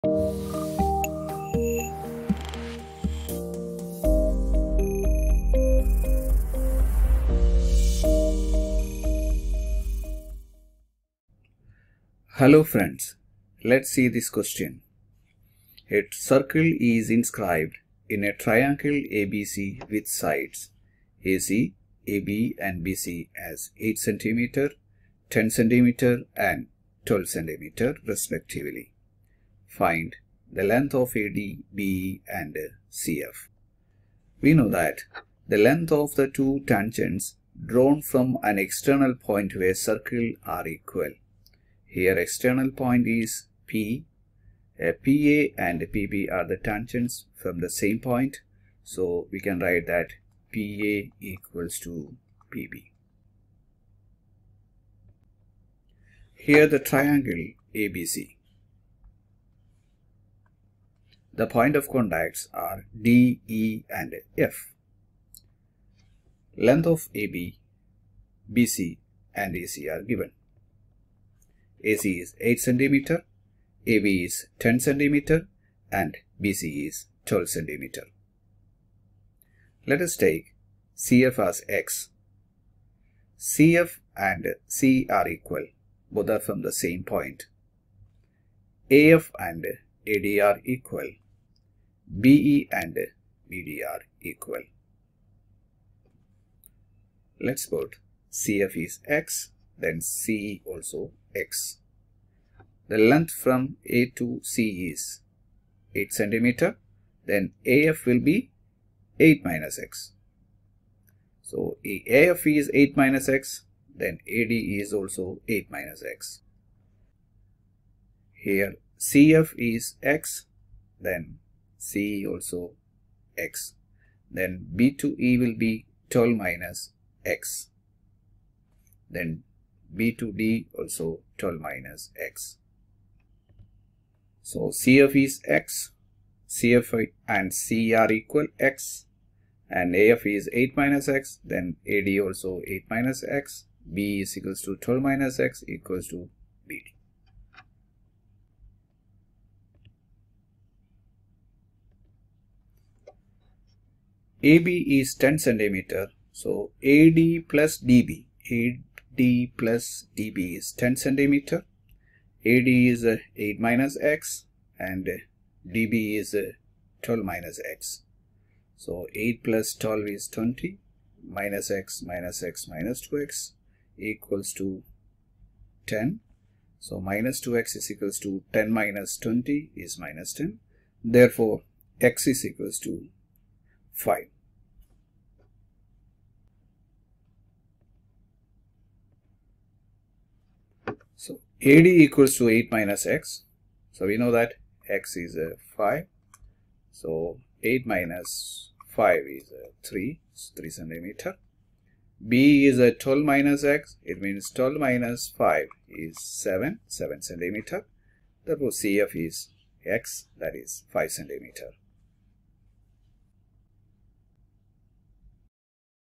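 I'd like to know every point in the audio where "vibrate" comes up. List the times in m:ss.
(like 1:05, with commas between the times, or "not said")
not said.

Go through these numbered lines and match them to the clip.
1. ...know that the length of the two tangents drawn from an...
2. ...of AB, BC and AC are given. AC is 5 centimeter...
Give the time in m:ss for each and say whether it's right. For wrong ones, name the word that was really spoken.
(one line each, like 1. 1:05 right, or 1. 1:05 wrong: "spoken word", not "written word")
1. 0:34 right
2. 1:06 wrong: "8", not "5".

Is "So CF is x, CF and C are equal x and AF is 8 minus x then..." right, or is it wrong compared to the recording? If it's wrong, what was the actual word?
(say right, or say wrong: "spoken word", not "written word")
right.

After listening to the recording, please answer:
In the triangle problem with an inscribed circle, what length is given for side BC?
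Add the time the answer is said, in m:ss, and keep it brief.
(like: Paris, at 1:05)
12 cm, at 1:16.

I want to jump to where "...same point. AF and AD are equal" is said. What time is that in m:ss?
1:26.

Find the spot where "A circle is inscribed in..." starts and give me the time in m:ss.
0:15.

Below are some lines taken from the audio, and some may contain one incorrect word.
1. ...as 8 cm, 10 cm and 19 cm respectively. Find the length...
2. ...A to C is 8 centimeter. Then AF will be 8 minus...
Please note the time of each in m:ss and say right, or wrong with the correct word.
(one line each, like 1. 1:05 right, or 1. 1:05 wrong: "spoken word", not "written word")
1. 0:23 wrong: "12", not "19"
2. 1:43 right.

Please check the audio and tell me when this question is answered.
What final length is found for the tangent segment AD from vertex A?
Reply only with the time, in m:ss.
3:20.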